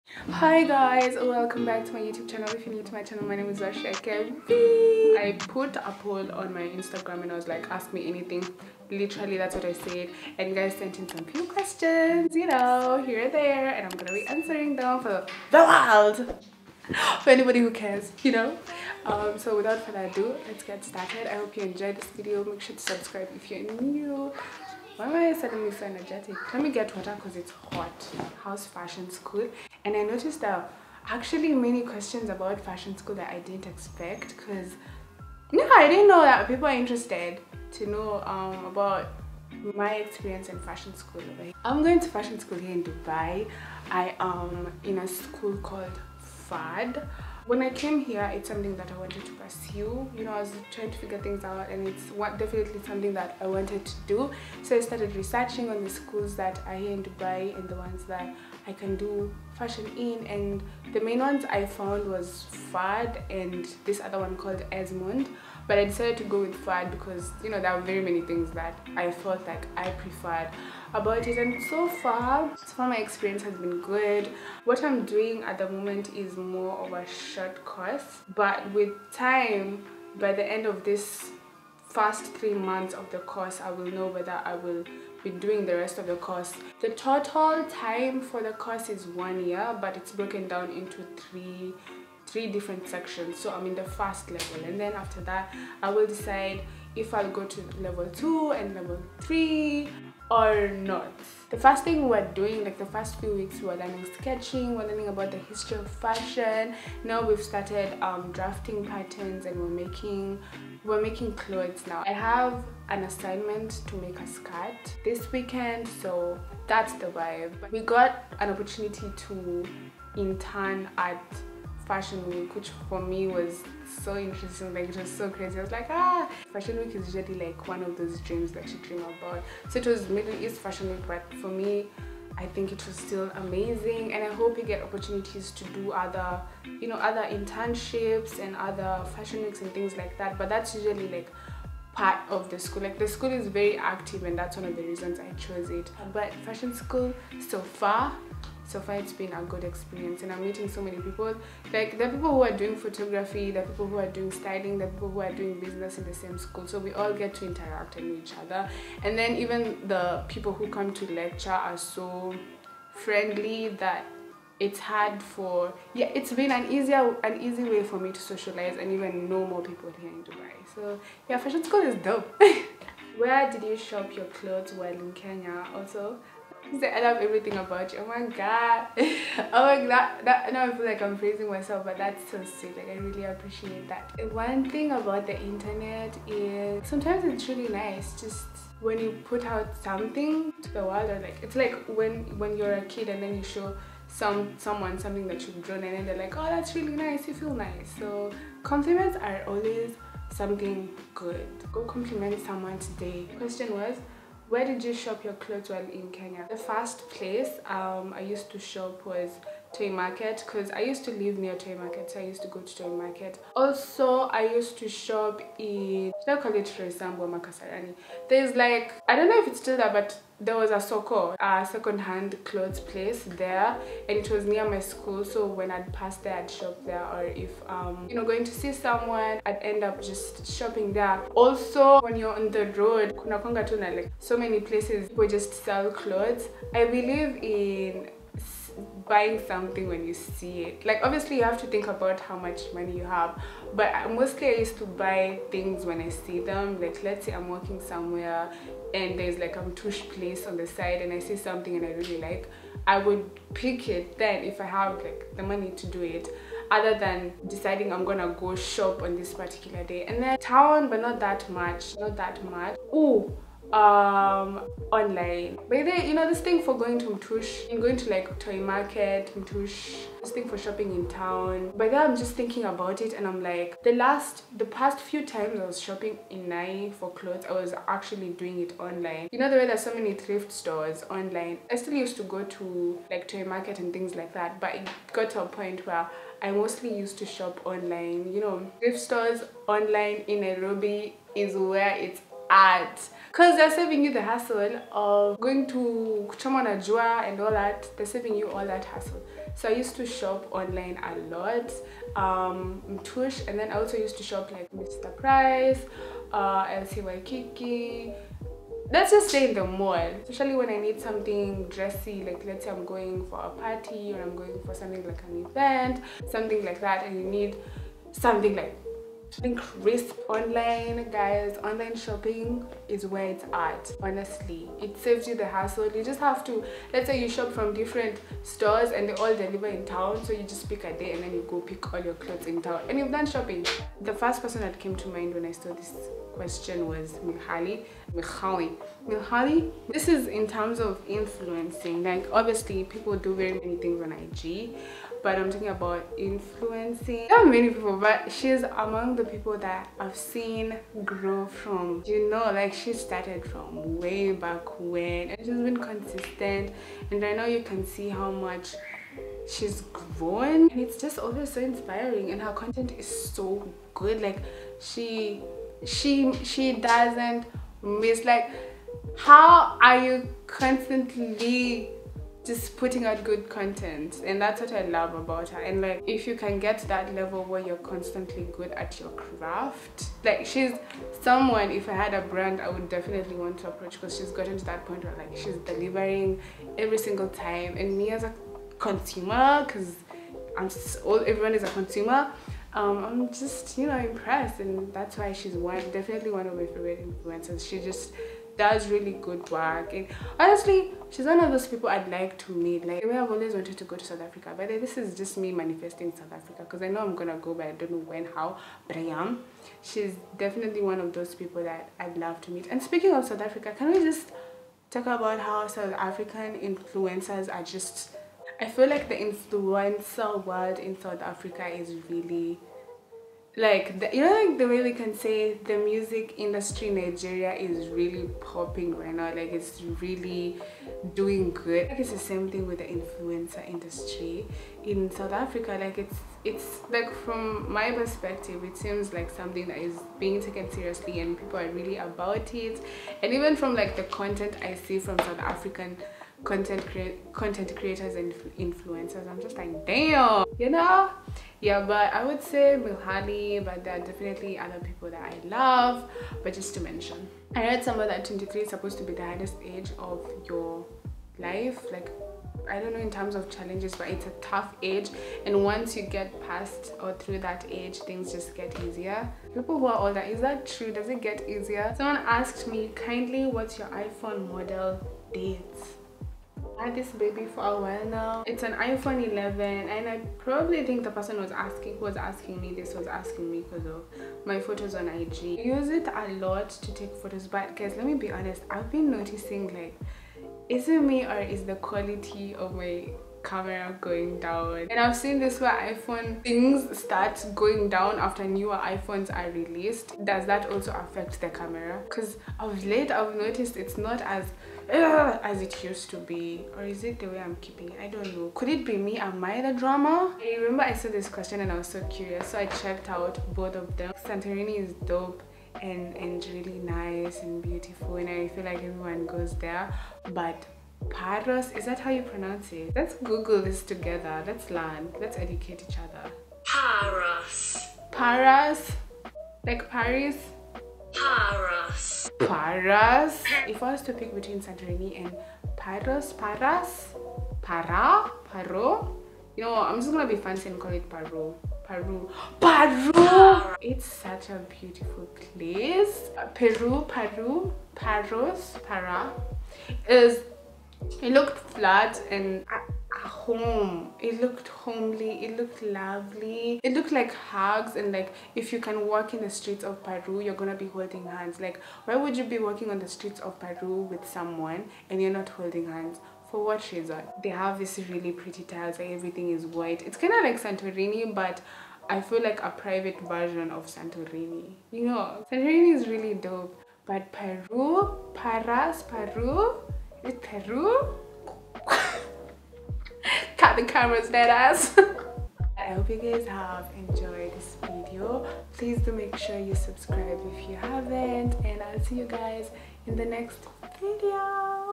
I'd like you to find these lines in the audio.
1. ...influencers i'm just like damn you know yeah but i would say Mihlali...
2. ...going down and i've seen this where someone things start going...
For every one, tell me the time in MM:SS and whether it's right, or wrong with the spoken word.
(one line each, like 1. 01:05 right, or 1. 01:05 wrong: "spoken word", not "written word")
1. 07:28 right
2. 08:14 wrong: "iphone", not "someone".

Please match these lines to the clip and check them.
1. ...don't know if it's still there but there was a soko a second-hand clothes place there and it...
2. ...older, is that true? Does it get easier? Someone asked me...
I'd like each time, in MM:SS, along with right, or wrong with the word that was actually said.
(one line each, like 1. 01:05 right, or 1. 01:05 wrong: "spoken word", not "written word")
1. 03:39 right
2. 07:50 right.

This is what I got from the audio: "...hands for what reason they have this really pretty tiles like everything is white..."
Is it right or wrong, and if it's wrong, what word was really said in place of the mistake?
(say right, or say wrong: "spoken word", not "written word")
right.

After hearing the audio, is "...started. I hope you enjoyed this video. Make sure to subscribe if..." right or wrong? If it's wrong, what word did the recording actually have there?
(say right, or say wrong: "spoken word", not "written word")
right.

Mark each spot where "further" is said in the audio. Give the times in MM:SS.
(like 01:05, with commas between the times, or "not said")
00:19.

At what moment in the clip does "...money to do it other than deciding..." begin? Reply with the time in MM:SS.
04:15.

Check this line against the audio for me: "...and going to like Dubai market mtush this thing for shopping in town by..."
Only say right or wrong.
wrong.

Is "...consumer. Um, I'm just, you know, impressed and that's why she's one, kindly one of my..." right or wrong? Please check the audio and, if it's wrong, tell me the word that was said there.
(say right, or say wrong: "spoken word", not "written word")
wrong: "definitely", not "kindly".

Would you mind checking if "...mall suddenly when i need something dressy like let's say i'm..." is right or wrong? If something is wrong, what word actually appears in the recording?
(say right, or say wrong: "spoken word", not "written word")
wrong: "especially", not "suddenly".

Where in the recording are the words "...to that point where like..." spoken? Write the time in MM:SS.
06:24.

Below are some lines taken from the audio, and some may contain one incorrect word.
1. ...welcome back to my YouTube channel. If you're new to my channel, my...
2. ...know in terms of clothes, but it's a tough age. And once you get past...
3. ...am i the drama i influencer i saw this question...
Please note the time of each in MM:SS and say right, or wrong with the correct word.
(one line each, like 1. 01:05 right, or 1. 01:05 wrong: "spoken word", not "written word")
1. 00:01 right
2. 07:42 wrong: "challenges", not "clothes"
3. 08:29 wrong: "remember", not "influencer".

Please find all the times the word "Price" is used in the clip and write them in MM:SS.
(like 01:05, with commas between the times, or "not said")
05:05.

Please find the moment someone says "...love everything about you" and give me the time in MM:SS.
02:57.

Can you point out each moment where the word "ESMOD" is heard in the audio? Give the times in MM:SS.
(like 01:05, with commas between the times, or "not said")
01:04.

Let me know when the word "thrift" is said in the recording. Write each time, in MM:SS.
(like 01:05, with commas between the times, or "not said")
04:40, 04:48.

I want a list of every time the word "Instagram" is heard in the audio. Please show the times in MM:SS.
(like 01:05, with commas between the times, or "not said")
00:06.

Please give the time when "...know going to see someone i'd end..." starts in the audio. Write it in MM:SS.
03:48.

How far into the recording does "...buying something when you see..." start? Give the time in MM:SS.
03:59.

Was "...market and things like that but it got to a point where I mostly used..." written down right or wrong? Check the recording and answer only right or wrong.
right.